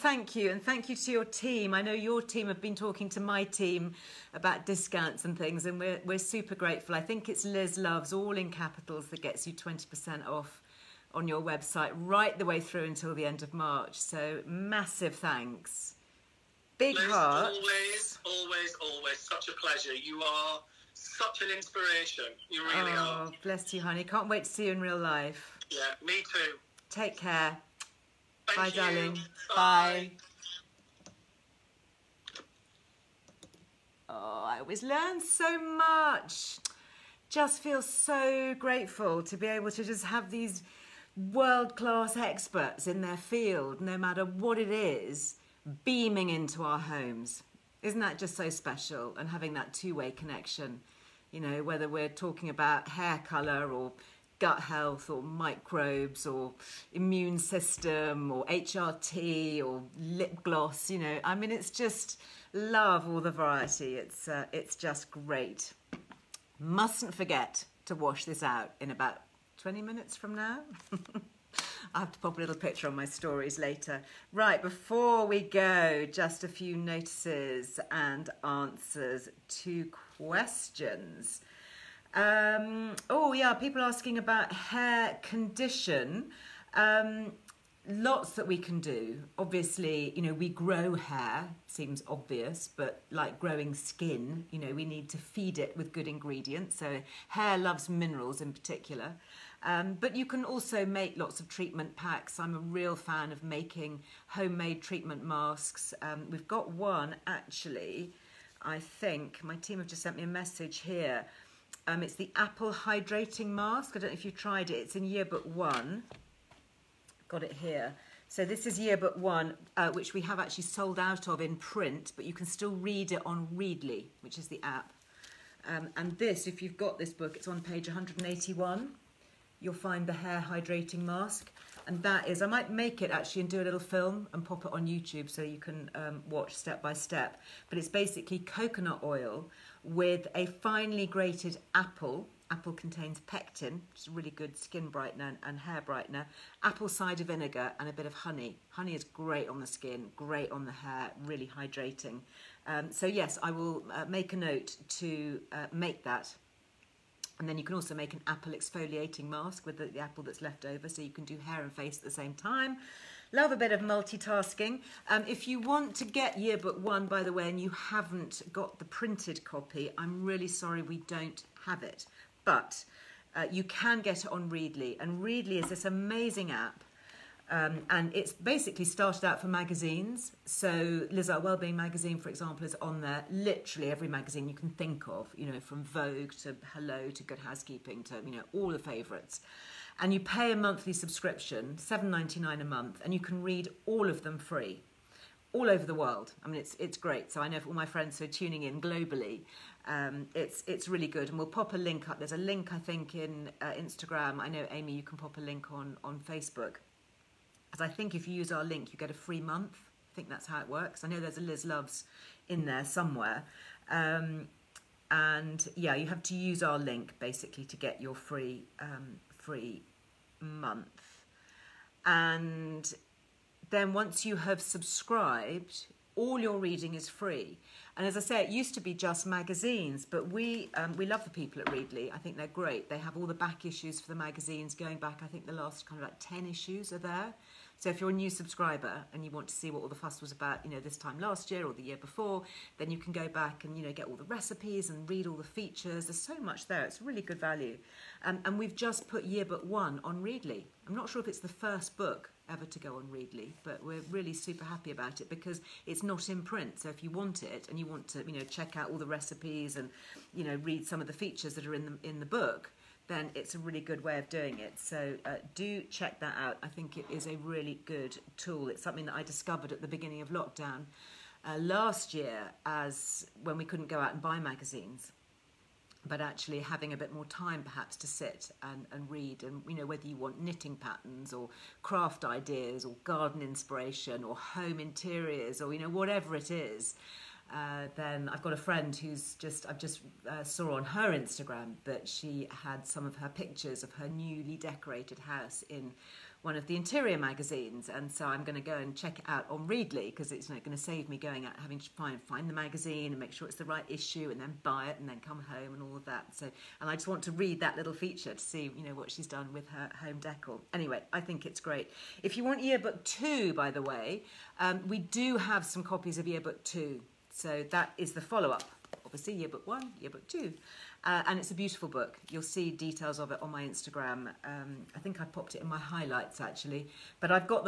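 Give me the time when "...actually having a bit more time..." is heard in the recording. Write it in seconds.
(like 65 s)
276 s.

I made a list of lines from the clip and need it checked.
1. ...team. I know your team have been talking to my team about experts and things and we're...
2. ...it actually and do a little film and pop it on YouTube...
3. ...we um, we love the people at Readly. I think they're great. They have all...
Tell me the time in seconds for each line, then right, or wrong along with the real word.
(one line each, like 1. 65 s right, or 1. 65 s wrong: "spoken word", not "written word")
1. 1 s wrong: "discounts", not "experts"
2. 133 s right
3. 230 s right.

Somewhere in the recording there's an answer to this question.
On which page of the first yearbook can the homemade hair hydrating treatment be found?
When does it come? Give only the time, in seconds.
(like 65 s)
127 s.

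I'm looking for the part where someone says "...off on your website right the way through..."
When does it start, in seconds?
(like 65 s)
10 s.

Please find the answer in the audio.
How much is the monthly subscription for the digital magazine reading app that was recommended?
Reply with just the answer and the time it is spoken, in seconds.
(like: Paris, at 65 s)
£7.99, at 191 s.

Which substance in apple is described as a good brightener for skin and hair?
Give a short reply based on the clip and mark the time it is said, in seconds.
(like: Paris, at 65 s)
Pectin, at 143 s.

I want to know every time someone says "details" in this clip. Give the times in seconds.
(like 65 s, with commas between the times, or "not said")
322 s.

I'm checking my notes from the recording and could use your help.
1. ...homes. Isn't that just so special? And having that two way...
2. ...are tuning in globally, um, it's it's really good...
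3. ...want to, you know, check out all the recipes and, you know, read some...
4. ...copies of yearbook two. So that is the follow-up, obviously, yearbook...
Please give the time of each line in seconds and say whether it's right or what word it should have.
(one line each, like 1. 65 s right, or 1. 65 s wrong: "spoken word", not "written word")
1. 46 s right
2. 198 s right
3. 257 s right
4. 315 s right.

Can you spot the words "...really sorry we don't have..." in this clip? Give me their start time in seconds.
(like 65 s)
170 s.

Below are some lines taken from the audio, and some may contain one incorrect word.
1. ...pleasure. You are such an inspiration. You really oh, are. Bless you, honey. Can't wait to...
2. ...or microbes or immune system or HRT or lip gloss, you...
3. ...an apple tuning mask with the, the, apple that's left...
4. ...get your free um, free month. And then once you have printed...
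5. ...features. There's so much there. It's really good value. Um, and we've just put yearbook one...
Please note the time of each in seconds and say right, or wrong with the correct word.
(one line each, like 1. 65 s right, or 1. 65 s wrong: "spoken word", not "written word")
1. 19 s right
2. 55 s right
3. 158 s wrong: "exfoliating", not "tuning"
4. 217 s wrong: "subscribed", not "printed"
5. 245 s right.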